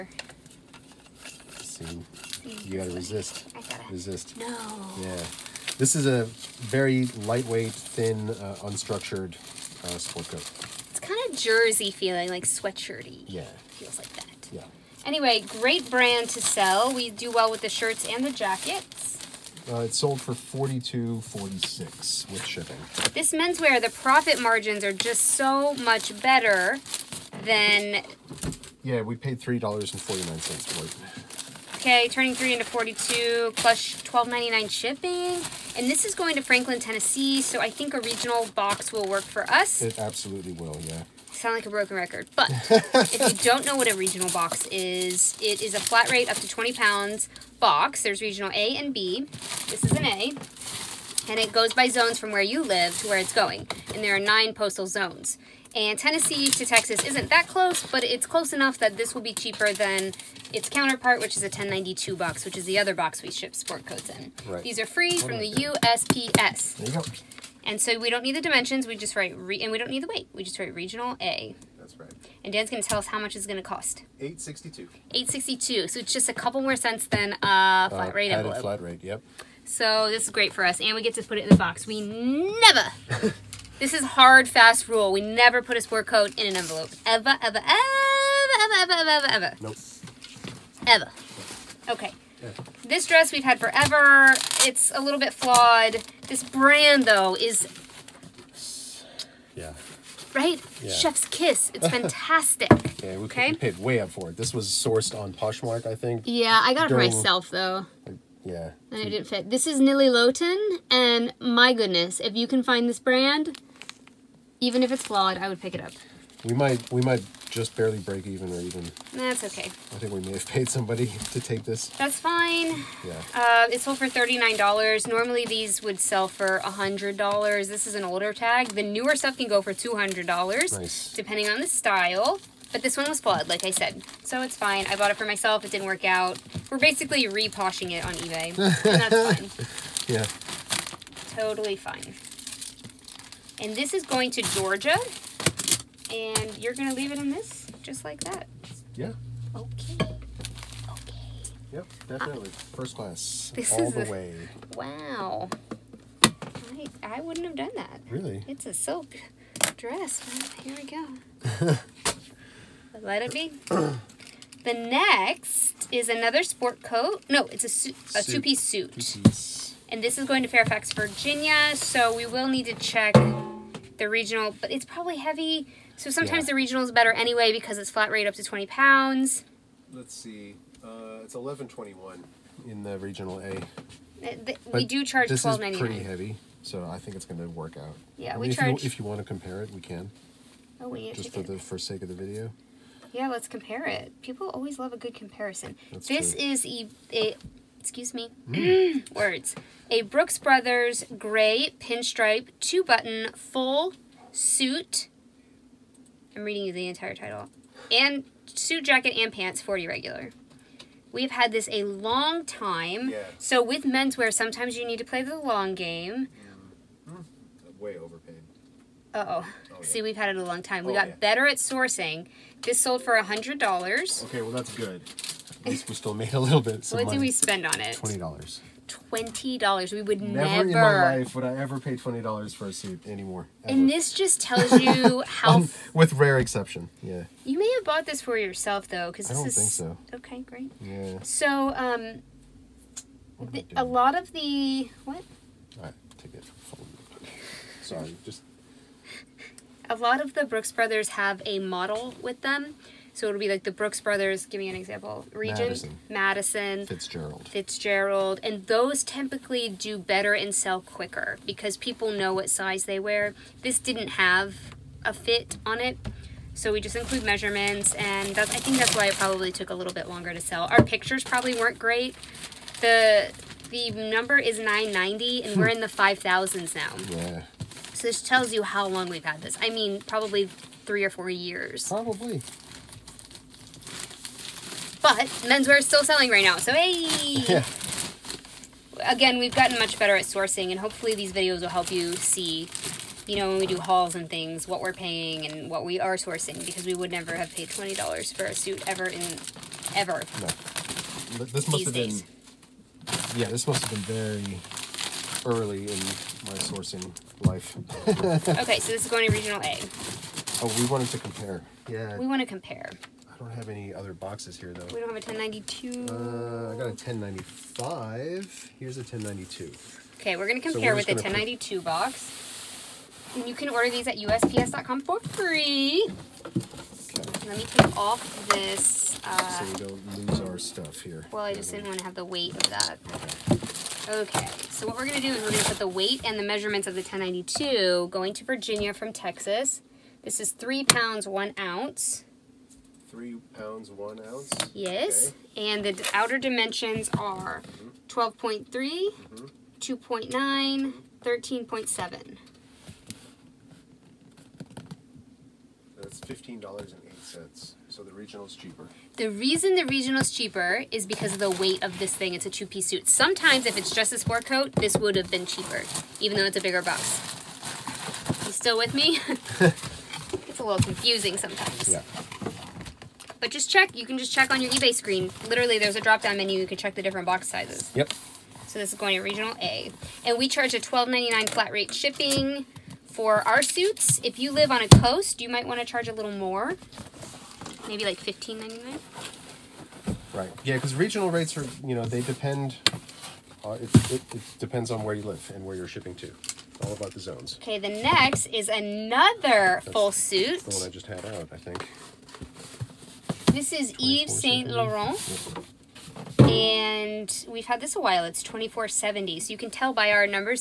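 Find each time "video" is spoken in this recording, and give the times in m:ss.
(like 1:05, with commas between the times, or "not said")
3:12, 4:51.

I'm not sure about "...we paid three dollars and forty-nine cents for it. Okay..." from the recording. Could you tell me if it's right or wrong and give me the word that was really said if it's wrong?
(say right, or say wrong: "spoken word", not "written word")
right.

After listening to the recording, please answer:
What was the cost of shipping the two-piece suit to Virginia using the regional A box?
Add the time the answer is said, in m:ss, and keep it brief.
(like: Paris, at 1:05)
$11.21, at 3:01.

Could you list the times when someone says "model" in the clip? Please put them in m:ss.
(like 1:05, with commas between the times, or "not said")
4:11.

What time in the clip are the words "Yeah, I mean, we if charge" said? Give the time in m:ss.
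3:08.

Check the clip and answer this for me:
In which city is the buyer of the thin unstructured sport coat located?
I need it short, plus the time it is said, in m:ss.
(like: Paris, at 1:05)
Franklin, Tennessee, at 0:36.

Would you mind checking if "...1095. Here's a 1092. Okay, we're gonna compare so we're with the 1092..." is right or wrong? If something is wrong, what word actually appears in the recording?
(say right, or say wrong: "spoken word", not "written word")
right.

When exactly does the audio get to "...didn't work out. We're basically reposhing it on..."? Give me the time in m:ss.
2:15.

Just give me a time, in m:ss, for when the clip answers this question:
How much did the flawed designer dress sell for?
2:04.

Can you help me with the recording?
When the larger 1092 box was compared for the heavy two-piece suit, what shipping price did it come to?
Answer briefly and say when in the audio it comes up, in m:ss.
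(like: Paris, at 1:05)
$15.08, at 5:56.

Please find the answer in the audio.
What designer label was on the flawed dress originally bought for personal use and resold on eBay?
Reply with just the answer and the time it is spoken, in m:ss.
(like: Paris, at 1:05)
Nili Lotan, at 1:49.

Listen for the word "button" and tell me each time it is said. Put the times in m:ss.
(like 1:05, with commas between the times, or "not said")
3:22.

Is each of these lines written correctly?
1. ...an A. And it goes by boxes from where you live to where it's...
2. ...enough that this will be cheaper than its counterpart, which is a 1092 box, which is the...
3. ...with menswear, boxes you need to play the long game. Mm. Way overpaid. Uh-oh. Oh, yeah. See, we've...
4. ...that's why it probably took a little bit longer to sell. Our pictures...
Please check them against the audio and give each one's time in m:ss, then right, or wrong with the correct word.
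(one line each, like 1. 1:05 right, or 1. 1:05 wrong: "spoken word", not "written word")
1. 0:49 wrong: "zones", not "boxes"
2. 0:58 right
3. 3:33 wrong: "sometimes", not "boxes"
4. 4:28 right.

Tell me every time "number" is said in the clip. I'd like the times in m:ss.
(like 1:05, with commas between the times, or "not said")
4:33.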